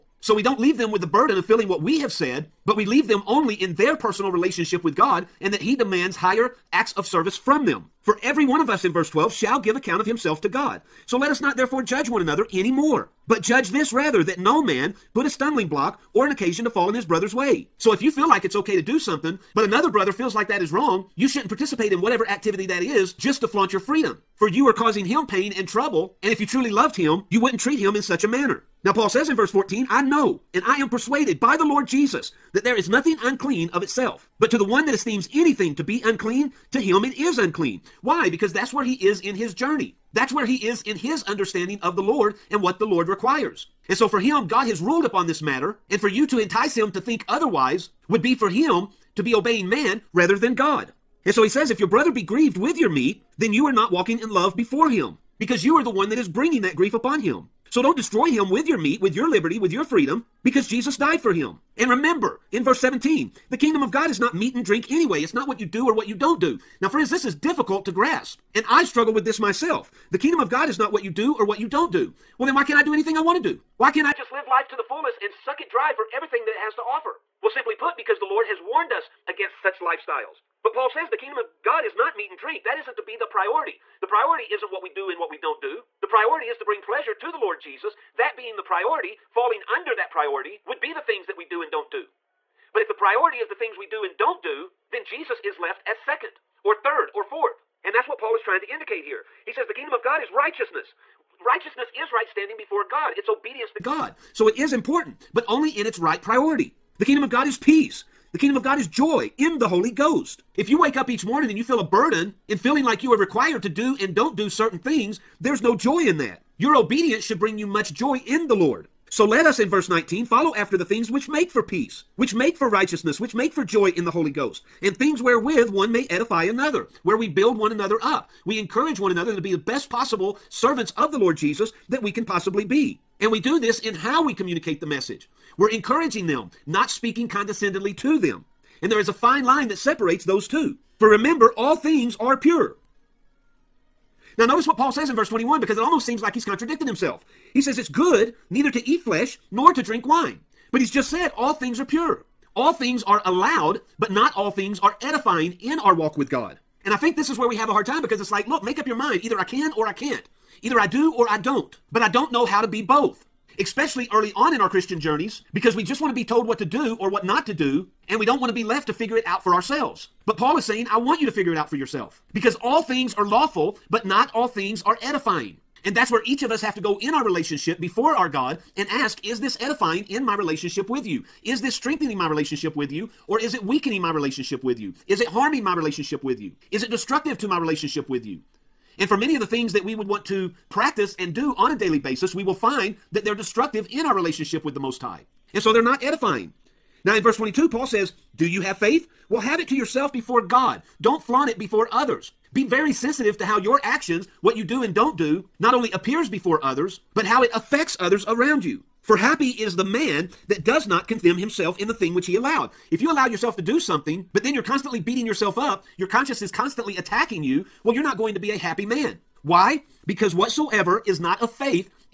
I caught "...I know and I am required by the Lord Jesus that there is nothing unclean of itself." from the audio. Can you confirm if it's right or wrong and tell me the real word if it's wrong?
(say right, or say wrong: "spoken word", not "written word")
wrong: "persuaded", not "required".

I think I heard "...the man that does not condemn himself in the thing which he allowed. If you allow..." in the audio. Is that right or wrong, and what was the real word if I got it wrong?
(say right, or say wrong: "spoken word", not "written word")
right.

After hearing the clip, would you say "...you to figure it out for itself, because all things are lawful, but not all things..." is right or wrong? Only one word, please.
wrong.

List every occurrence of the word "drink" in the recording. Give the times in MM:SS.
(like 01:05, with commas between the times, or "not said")
01:04, 01:22, 02:29.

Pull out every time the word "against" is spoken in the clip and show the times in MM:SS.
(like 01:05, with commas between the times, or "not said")
01:19.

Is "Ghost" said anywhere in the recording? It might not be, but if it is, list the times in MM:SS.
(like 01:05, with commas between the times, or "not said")
01:49, 02:04.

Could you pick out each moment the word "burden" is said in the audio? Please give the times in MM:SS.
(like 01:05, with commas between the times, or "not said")
00:01, 01:51.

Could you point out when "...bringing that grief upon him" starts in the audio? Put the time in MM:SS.
00:56.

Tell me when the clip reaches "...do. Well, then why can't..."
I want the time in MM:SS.
01:11.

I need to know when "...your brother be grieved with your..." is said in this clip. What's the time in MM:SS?
00:51.